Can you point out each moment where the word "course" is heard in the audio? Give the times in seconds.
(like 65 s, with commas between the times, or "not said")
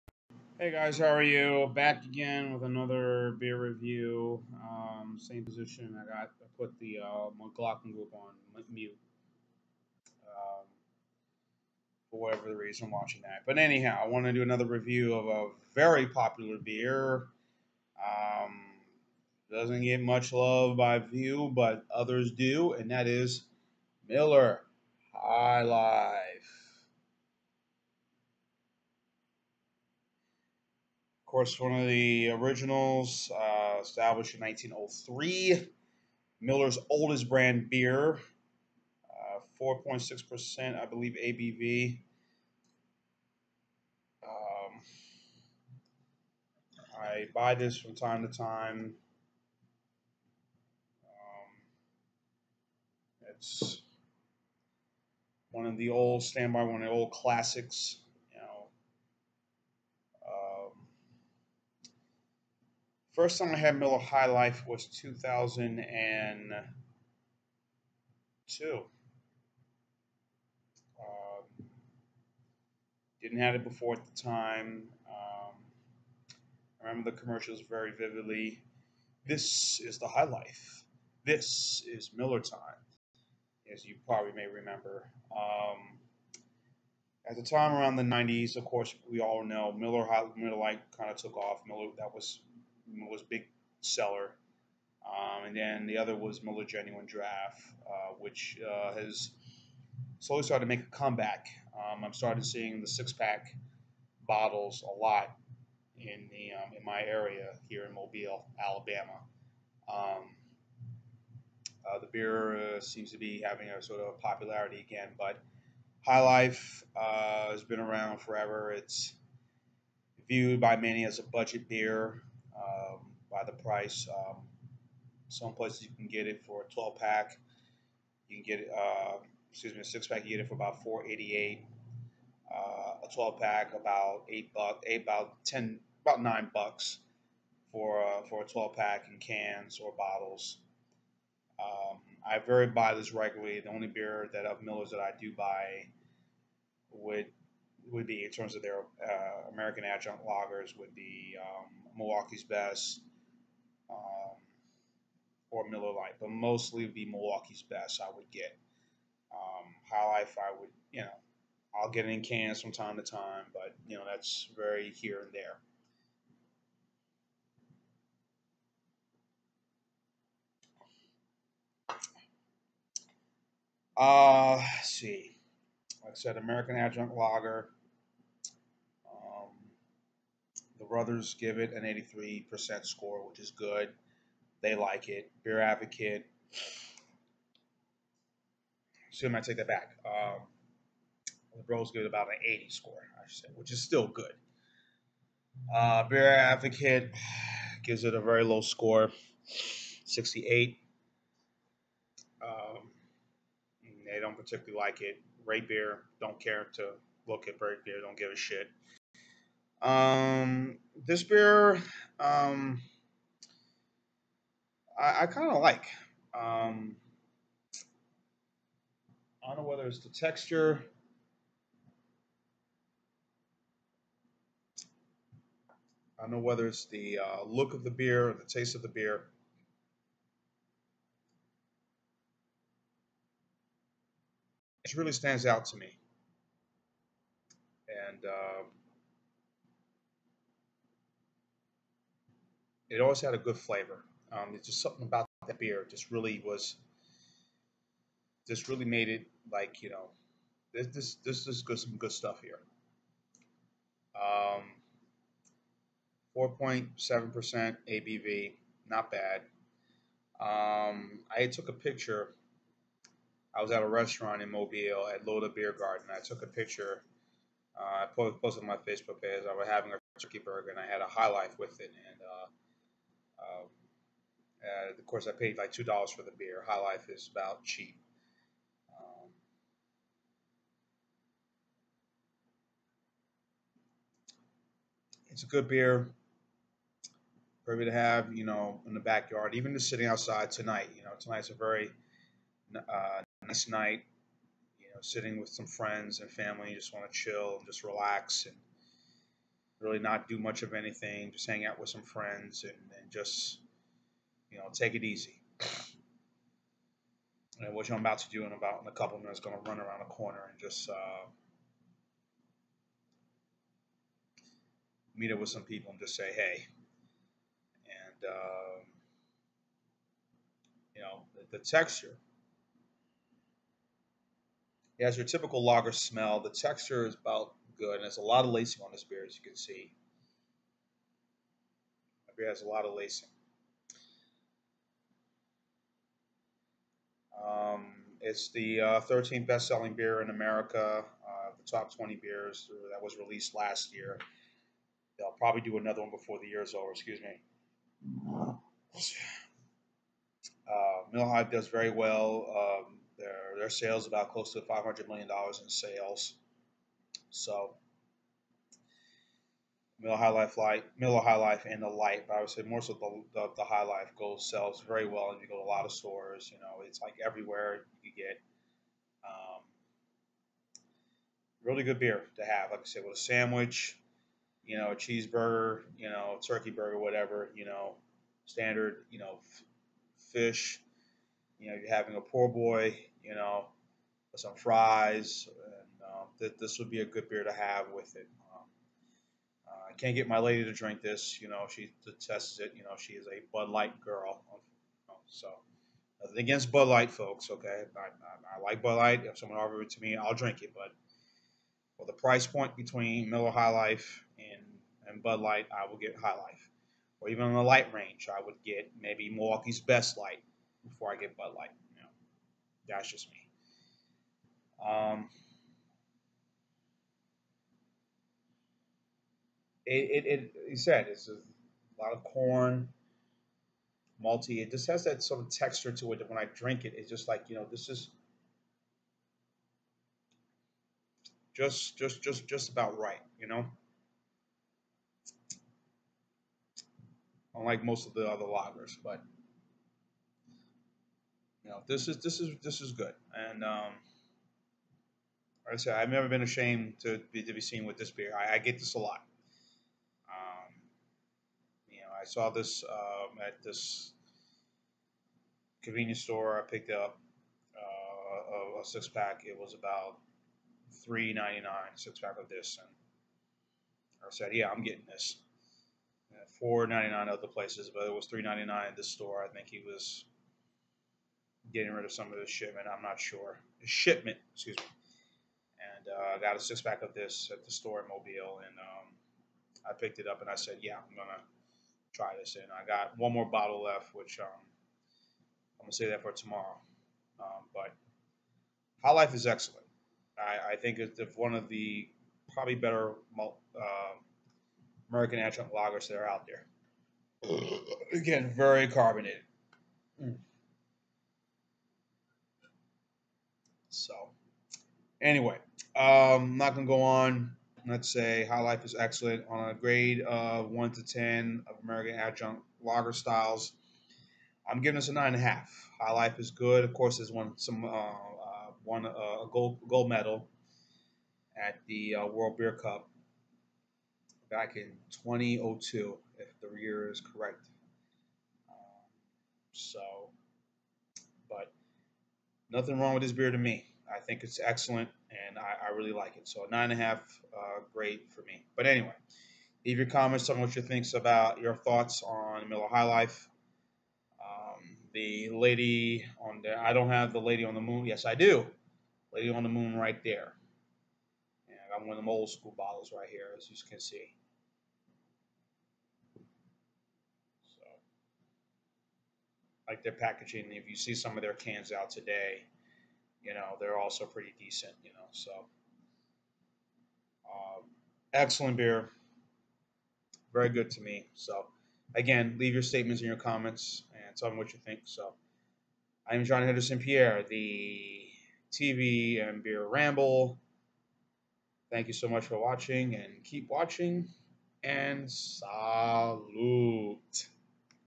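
31 s, 88 s, 275 s, 516 s.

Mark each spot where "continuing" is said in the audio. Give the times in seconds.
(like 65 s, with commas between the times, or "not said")
not said.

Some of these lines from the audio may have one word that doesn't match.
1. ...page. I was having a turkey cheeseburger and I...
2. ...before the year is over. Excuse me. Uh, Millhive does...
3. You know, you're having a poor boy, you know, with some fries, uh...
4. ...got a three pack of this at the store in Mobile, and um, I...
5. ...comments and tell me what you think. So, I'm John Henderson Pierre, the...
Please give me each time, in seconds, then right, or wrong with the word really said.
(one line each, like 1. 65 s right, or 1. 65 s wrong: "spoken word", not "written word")
1. 269 s wrong: "burger", not "cheeseburger"
2. 346 s right
3. 381 s right
4. 476 s wrong: "six", not "three"
5. 573 s right.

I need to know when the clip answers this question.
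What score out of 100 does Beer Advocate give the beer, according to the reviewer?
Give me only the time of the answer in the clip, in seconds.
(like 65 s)
200 s.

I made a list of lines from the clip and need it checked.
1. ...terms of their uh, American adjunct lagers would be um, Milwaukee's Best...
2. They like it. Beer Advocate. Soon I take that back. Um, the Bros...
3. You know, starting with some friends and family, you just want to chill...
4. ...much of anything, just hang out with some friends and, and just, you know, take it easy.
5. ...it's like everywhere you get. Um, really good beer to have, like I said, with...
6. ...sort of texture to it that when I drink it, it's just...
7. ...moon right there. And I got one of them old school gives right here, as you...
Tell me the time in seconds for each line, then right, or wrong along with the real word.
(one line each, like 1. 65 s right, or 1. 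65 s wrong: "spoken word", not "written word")
1. 148 s right
2. 184 s right
3. 294 s wrong: "sitting", not "starting"
4. 300 s right
5. 366 s right
6. 425 s right
7. 549 s wrong: "bottles", not "gives".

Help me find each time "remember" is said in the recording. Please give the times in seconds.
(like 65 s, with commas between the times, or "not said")
76 s, 84 s.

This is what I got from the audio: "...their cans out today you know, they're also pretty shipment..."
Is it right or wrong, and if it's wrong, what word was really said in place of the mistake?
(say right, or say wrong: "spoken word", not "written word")
wrong: "decent", not "shipment".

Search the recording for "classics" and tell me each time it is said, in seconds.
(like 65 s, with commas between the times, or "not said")
57 s.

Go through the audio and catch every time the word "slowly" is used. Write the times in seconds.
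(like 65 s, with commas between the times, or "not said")
100 s.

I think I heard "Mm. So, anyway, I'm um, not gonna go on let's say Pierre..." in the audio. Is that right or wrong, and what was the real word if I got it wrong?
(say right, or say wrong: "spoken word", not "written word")
wrong: "High", not "Pierre".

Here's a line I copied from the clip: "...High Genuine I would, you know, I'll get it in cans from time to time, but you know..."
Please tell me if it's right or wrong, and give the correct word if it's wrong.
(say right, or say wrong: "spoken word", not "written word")
wrong: "Life", not "Genuine".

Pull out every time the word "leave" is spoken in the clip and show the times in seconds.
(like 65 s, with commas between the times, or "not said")
539 s, 572 s.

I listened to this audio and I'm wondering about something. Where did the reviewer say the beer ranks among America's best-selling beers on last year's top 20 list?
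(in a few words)
13th.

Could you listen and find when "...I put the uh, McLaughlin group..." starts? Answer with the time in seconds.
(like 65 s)
6 s.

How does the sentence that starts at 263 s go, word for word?
I was at a restaurant in Mobile at Loda Beer Garden.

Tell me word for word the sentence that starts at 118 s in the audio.
It's viewed by many as a budget beer by the price.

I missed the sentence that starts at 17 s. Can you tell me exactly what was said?
Um, doesn't get much love by few, but others do, and that is Miller High Life.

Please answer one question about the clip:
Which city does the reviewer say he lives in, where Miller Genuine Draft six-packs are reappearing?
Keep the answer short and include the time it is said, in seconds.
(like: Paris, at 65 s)
Mobile, Alabama, at 107 s.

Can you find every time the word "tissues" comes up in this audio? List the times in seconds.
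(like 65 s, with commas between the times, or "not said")
not said.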